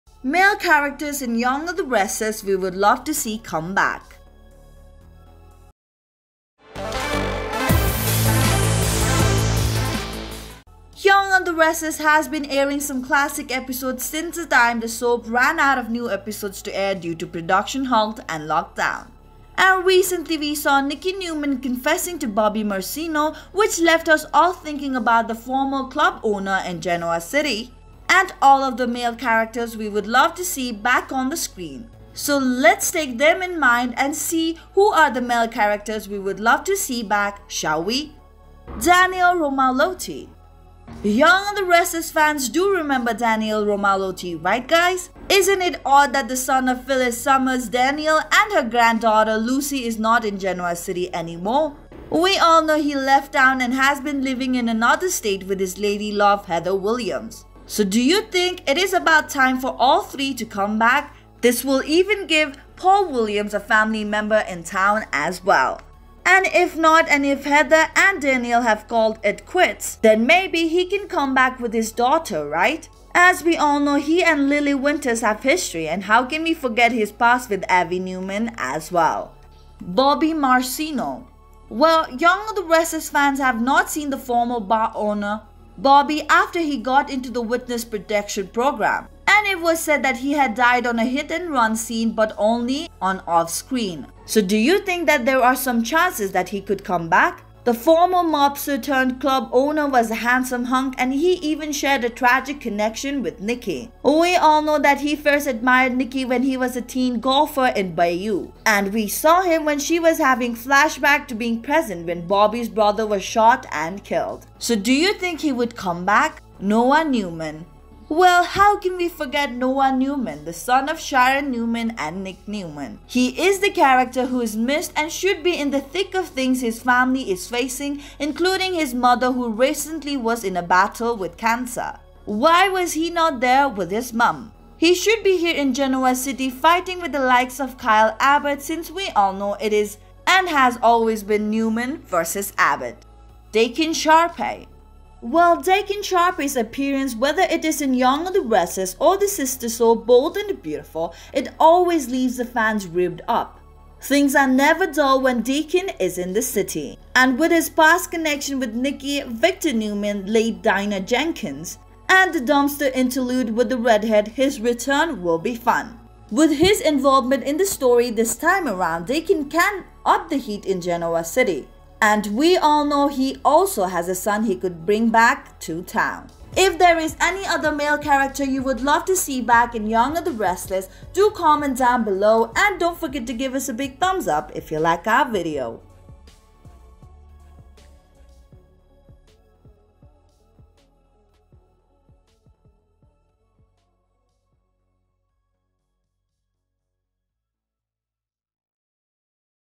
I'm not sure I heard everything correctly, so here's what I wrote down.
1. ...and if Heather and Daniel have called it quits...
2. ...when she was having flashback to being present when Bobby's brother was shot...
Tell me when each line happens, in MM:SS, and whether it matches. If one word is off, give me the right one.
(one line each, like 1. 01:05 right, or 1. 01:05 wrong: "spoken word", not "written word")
1. 01:07 right
2. 01:49 right.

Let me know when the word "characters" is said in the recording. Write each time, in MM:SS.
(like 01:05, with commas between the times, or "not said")
00:00, 00:29, 00:35, 02:03, 02:57.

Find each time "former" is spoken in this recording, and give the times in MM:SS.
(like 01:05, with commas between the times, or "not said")
00:25, 01:24, 01:37.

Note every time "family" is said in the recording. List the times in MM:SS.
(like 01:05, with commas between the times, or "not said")
01:03, 02:06.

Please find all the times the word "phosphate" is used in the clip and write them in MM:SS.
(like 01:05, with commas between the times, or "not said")
not said.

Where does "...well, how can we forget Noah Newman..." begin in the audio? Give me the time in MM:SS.
01:58.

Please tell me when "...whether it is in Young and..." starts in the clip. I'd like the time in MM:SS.
02:27.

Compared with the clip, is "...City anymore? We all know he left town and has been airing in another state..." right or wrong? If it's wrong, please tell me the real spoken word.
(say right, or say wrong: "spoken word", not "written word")
wrong: "living", not "airing".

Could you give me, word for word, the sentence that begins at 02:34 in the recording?
Things are never dull when Deacon is in the city.